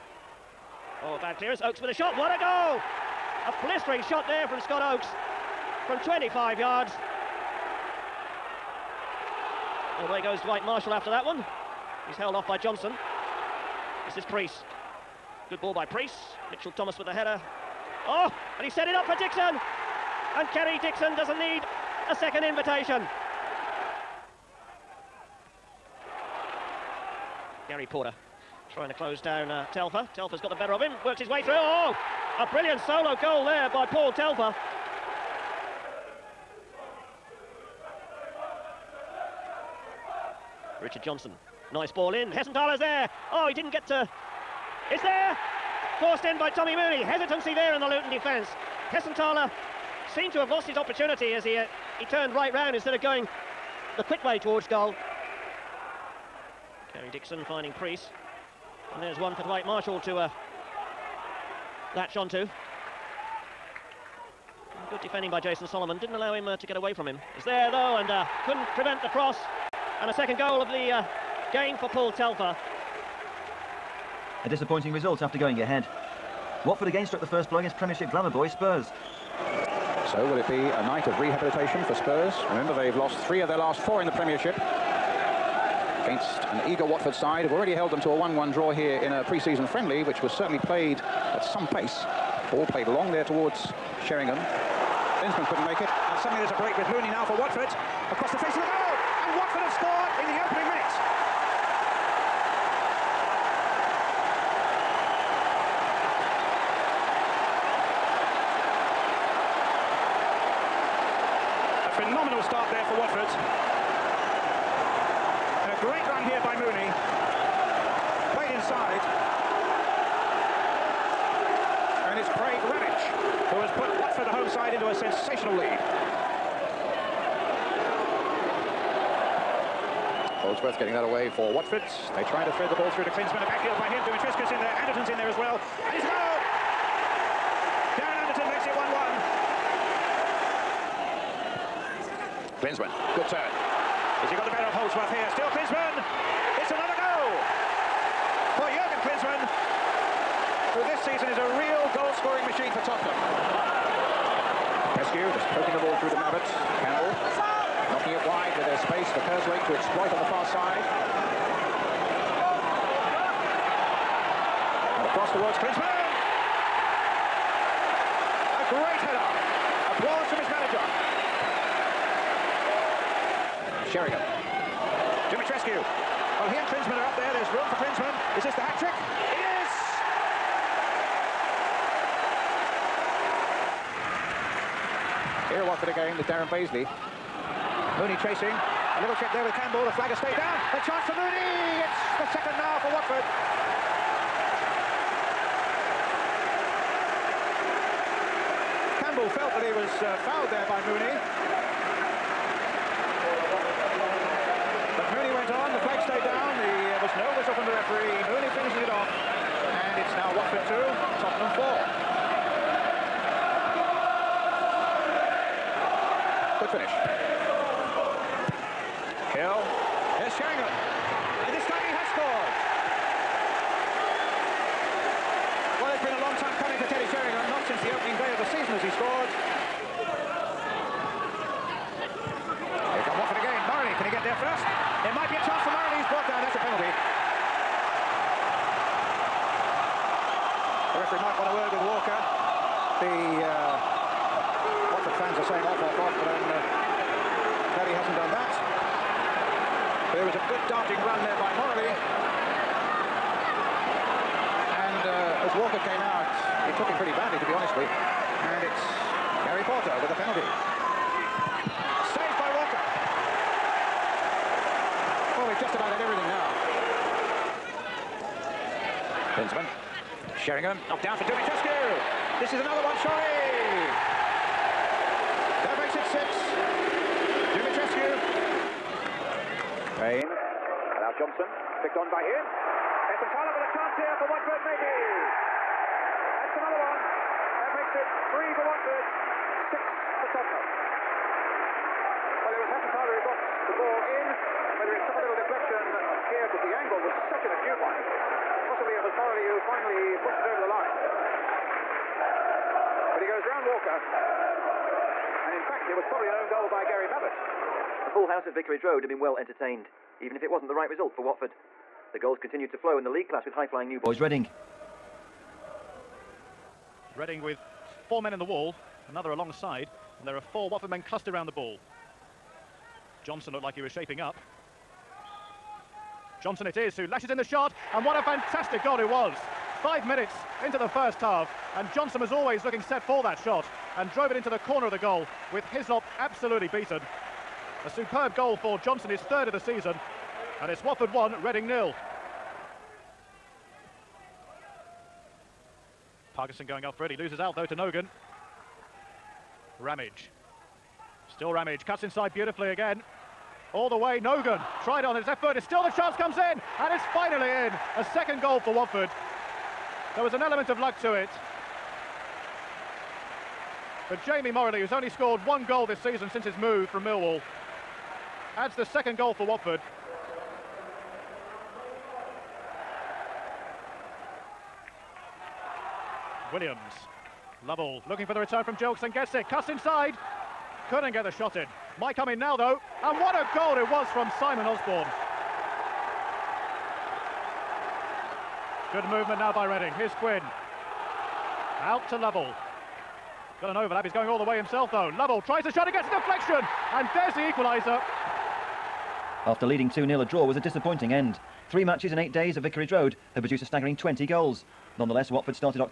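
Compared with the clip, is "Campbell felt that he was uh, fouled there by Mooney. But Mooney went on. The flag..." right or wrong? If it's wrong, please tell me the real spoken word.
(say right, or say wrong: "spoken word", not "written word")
right.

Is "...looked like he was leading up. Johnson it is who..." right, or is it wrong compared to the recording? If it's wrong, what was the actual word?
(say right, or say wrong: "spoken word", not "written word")
wrong: "shaping", not "leading".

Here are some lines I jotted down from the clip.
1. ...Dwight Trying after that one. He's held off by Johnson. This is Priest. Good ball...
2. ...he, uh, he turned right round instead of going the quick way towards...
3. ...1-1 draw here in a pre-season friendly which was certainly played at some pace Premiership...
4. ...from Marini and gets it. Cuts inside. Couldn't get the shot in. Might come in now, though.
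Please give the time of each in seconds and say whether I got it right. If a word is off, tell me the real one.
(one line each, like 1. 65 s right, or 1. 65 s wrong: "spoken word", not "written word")
1. 10 s wrong: "Marshall", not "Trying"
2. 51 s right
3. 88 s wrong: "Ball", not "Premiership"
4. 378 s wrong: "Jokes", not "Marini".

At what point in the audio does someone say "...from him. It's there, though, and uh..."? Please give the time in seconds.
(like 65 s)
66 s.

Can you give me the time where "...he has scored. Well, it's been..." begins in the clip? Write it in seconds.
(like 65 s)
221 s.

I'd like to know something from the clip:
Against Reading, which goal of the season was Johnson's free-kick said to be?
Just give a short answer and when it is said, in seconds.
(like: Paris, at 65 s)
3rd, at 339 s.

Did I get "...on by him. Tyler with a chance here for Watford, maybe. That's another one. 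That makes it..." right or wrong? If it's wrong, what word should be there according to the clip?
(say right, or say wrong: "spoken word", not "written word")
right.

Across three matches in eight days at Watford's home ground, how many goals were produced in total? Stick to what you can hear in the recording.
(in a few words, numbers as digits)
20.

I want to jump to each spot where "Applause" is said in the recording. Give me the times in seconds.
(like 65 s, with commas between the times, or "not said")
169 s.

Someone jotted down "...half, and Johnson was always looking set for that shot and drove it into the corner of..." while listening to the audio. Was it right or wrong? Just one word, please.
right.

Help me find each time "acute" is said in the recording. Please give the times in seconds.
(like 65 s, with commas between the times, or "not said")
297 s.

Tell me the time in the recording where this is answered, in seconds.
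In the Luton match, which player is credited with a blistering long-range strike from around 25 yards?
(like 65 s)
4 s.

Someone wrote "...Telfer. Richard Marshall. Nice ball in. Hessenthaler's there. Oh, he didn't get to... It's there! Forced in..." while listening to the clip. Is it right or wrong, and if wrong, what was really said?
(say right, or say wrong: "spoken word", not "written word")
wrong: "Johnson", not "Marshall".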